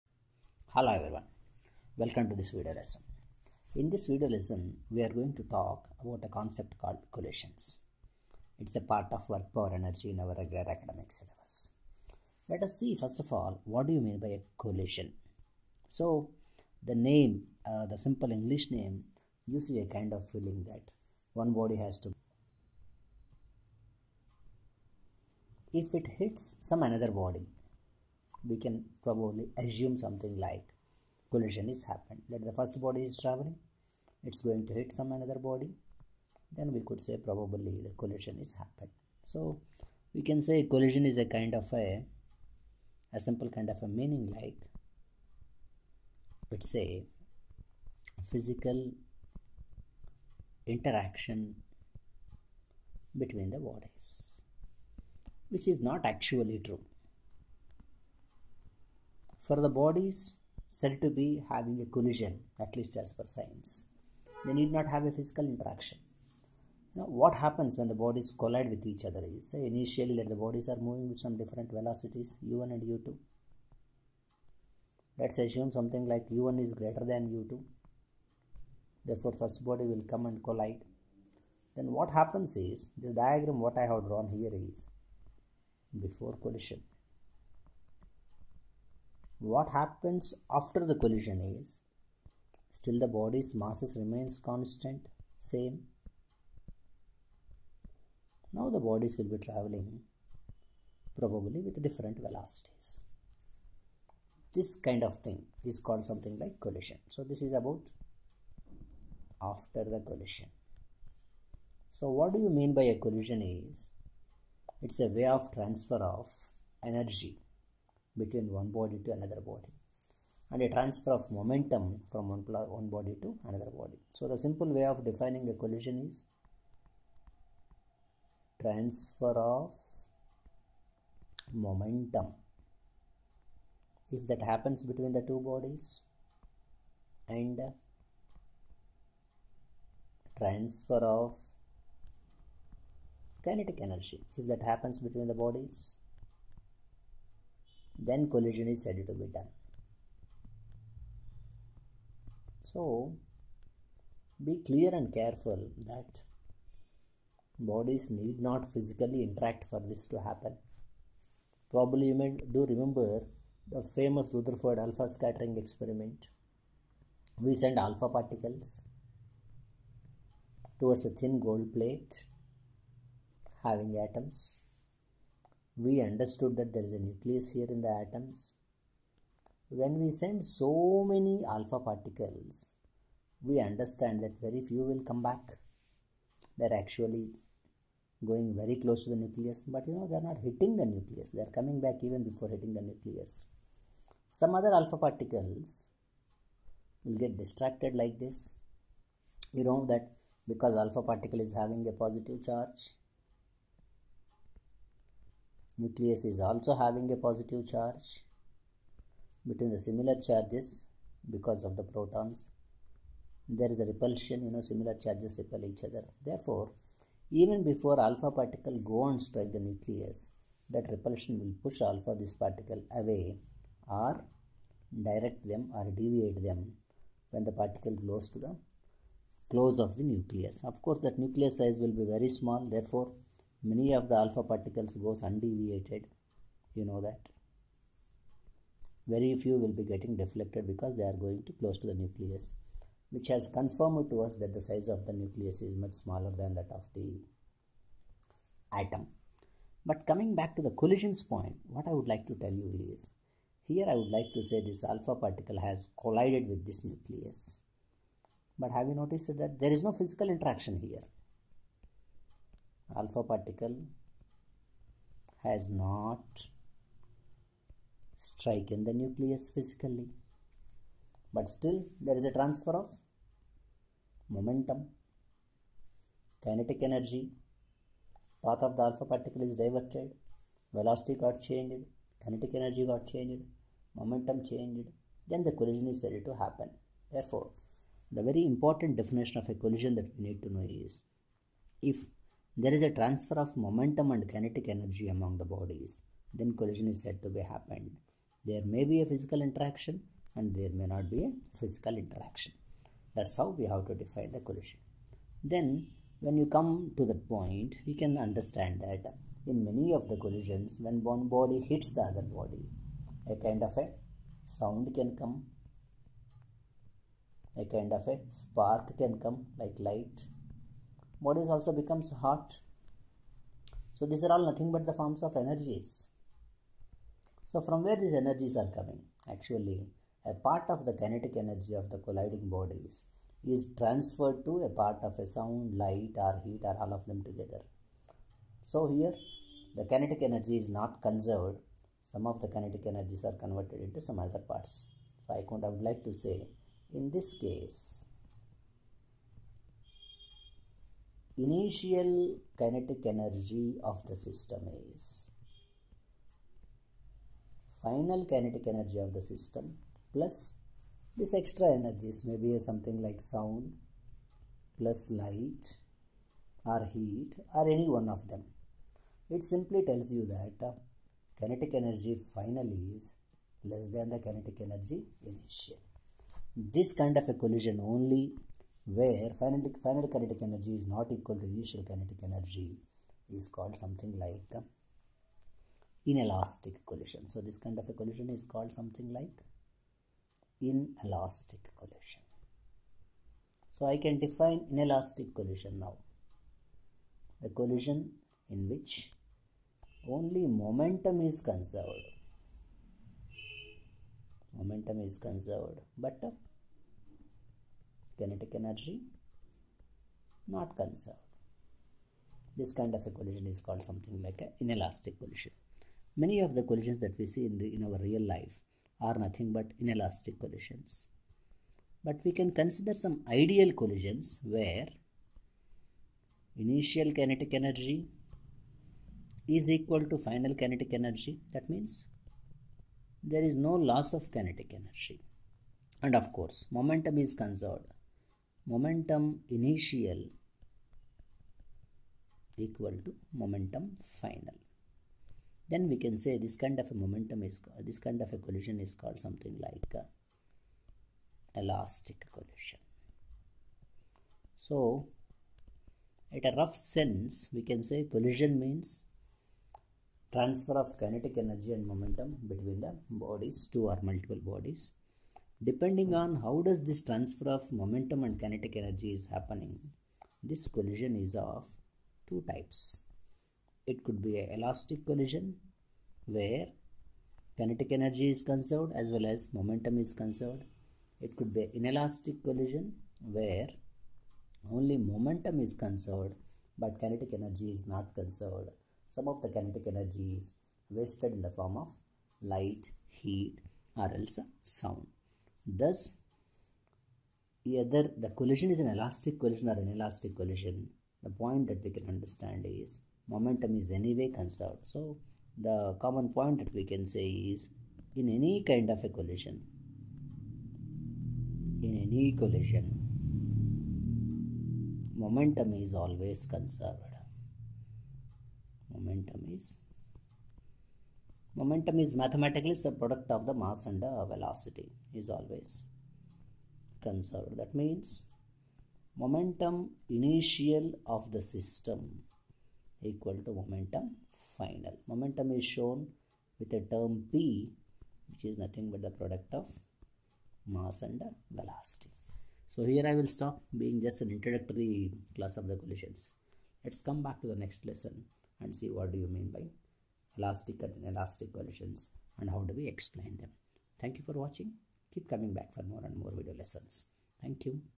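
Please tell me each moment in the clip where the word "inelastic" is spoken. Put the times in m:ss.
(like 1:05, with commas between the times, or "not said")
6:26, 6:30, 6:34, 6:54, 6:59, 8:01.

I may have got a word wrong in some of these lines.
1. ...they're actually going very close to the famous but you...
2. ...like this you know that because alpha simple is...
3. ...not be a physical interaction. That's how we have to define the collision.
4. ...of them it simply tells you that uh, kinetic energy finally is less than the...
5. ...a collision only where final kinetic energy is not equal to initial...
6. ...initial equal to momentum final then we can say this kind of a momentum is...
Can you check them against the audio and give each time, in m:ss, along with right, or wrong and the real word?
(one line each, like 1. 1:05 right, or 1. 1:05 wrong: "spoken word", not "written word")
1. 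3:06 wrong: "nucleus", not "famous"
2. 3:17 wrong: "particle", not "simple"
3. 5:00 right
4. 6:08 right
5. 6:17 right
6. 7:19 right.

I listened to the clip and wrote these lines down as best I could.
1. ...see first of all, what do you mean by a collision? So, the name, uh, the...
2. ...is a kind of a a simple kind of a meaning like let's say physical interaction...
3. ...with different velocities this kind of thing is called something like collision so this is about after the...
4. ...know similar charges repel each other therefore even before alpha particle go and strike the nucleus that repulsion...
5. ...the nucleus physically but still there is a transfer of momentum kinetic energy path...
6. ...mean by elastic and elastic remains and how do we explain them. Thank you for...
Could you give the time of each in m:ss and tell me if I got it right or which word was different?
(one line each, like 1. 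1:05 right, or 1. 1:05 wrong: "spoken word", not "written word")
1. 0:12 right
2. 0:41 right
3. 1:41 right
4. 3:34 right
5. 4:28 right
6. 9:09 wrong: "collisions", not "remains".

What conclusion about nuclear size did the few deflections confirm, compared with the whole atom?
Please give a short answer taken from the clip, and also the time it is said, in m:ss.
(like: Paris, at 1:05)
Much smaller, at 4:05.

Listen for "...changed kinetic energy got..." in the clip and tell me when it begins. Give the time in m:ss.
4:41.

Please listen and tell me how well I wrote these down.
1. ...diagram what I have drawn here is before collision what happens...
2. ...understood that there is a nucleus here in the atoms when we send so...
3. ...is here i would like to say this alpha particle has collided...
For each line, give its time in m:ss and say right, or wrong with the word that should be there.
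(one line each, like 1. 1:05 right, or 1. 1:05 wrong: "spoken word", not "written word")
1. 1:23 right
2. 2:56 right
3. 4:12 right.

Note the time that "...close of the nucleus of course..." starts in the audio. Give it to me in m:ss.
3:49.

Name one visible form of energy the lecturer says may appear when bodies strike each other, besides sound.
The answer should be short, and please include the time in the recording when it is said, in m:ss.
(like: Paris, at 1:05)
Spark, at 5:17.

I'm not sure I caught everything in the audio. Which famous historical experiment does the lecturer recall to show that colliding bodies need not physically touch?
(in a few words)
Rutherford alpha scattering experiment.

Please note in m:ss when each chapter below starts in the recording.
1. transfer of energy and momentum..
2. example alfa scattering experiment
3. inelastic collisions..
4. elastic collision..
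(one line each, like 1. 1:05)
1. 2:00
2. 3:00
3. 5:00
4. 7:30.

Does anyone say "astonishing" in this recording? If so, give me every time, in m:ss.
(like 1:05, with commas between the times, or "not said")
not said.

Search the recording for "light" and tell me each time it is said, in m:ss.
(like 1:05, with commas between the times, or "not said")
5:19, 5:35, 6:05, 8:12.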